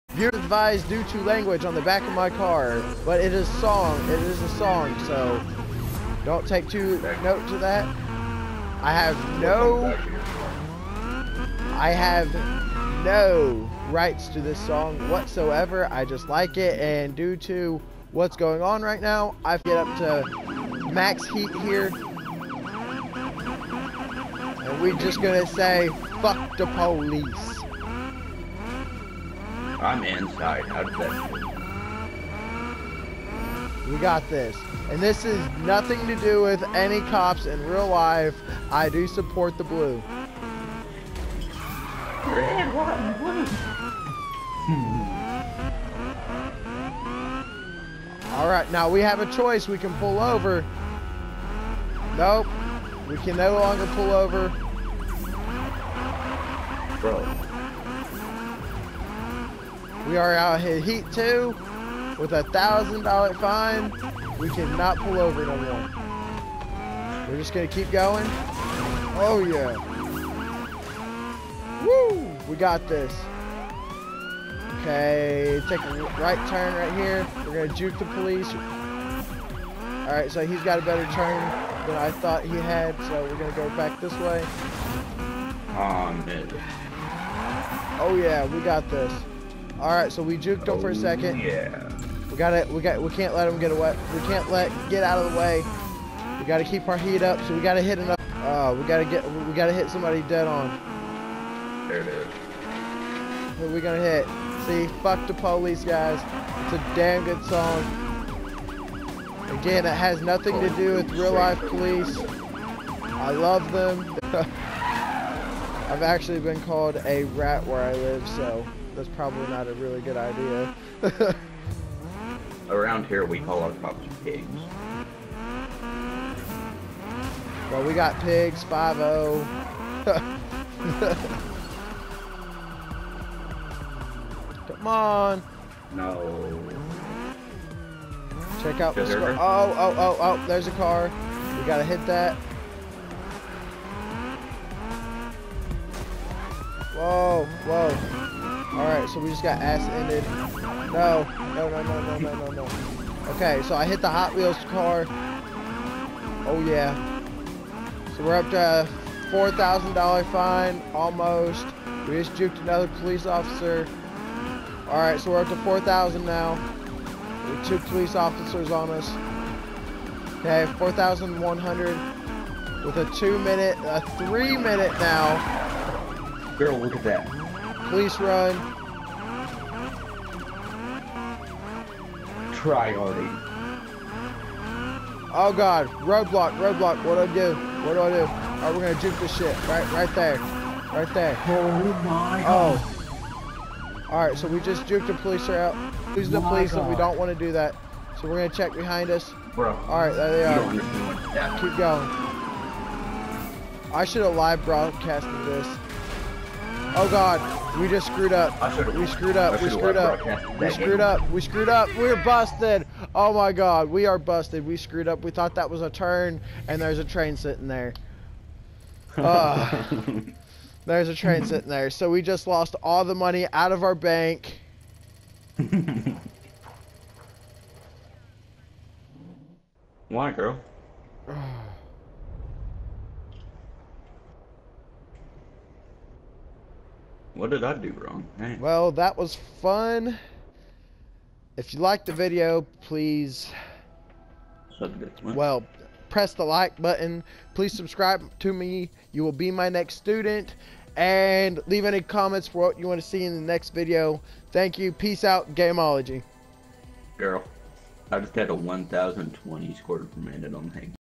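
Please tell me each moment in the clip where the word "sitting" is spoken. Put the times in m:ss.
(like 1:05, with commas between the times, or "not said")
3:37, 3:41.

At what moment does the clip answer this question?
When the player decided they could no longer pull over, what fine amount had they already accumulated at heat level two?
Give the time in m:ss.
1:02.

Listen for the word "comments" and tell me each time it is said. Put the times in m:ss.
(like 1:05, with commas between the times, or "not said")
4:12.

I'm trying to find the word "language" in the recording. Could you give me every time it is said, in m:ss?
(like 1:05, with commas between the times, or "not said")
0:01.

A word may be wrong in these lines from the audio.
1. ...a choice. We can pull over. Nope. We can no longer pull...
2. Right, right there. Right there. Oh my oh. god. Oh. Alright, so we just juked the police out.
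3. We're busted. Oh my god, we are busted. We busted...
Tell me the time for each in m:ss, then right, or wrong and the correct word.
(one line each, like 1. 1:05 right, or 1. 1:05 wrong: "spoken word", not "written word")
1. 0:49 right
2. 3:09 right
3. 3:31 wrong: "screwed", not "busted".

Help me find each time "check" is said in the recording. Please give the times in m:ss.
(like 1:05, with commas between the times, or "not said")
2:18, 3:18.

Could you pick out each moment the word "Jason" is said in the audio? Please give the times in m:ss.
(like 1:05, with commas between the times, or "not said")
not said.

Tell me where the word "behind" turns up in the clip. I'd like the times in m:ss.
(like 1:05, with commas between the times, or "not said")
3:18.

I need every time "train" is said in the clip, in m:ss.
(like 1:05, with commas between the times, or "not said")
3:37, 3:41.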